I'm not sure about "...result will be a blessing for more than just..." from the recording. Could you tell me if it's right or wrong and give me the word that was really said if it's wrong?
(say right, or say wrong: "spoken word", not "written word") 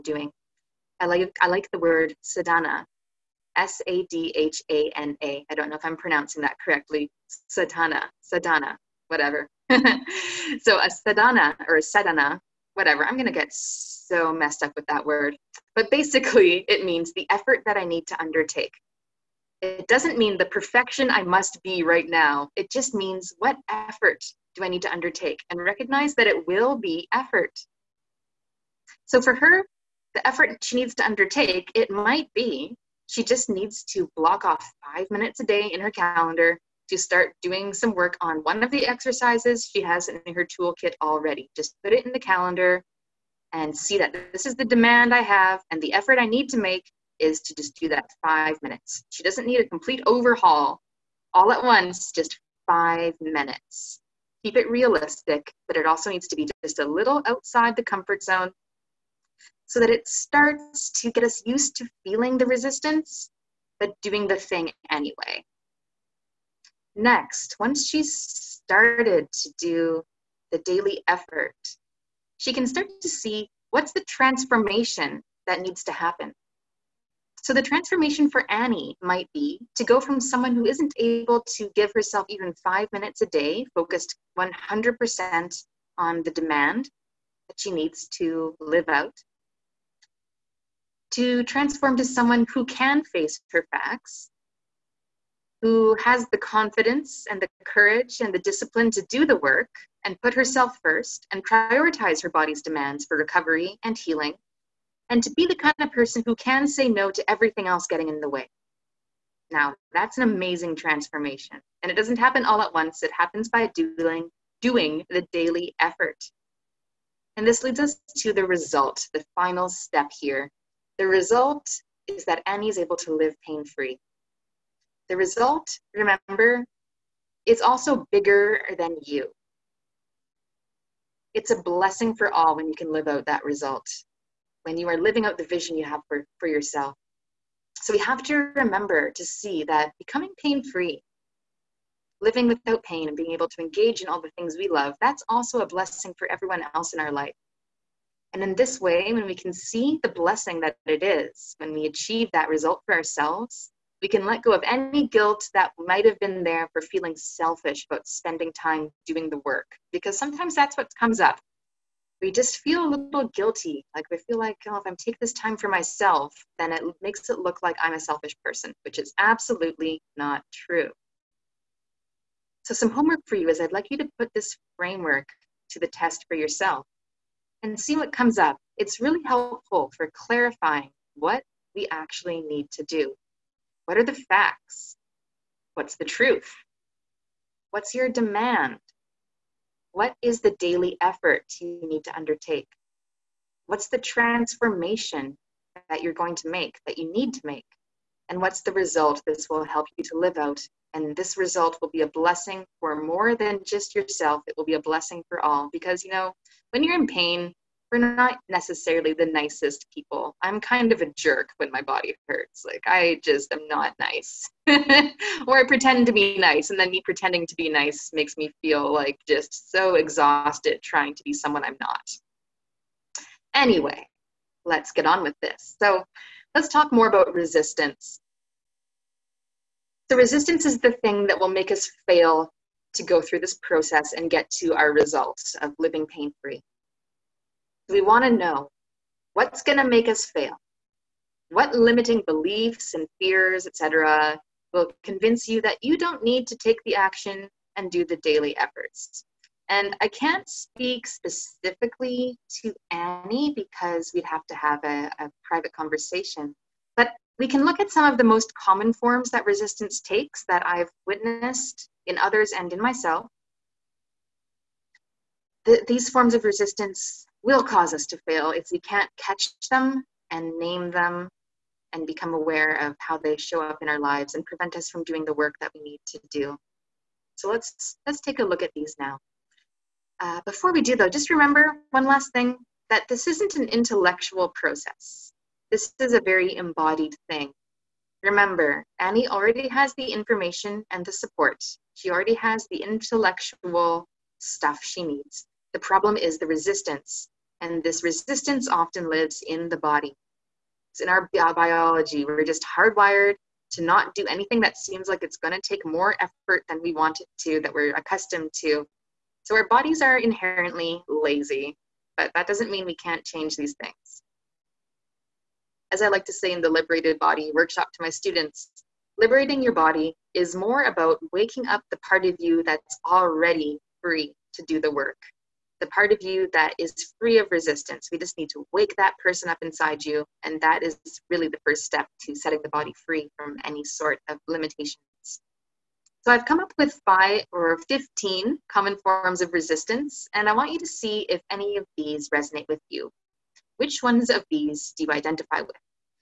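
right.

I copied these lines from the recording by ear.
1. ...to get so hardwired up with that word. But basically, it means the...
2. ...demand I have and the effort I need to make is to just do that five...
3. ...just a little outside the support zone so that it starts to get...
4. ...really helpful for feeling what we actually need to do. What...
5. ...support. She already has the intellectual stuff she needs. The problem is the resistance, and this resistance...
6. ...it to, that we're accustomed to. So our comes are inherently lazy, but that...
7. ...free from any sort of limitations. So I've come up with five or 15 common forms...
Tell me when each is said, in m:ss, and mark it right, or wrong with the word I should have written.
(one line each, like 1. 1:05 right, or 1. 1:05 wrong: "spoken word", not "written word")
1. 0:13 wrong: "messed", not "hardwired"
2. 0:44 right
3. 0:56 wrong: "comfort", not "support"
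4. 2:59 wrong: "clarifying", not "feeling"
5. 4:51 right
6. 5:07 wrong: "bodies", not "comes"
7. 5:33 right.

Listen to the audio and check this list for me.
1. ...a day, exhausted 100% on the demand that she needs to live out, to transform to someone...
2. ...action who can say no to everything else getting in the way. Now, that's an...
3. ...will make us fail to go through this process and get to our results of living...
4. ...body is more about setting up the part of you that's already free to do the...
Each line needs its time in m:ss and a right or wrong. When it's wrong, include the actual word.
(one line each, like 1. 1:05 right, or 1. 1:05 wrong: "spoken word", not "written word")
1. 1:23 wrong: "focused", not "exhausted"
2. 1:45 wrong: "person", not "action"
3. 3:51 right
4. 5:19 wrong: "waking", not "setting".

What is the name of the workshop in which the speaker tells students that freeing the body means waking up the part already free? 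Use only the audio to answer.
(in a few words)
Liberated Body workshop.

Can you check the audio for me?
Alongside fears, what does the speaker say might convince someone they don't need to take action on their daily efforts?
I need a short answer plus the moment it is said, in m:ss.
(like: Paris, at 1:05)
limiting beliefs, at 4:01.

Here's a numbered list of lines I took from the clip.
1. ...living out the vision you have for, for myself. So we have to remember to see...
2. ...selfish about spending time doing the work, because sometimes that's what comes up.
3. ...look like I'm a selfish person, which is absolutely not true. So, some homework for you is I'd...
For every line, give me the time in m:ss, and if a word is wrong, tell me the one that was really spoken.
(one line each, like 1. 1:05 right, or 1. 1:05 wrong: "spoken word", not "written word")
1. 2:14 wrong: "yourself", not "myself"
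2. 2:37 right
3. 2:47 right.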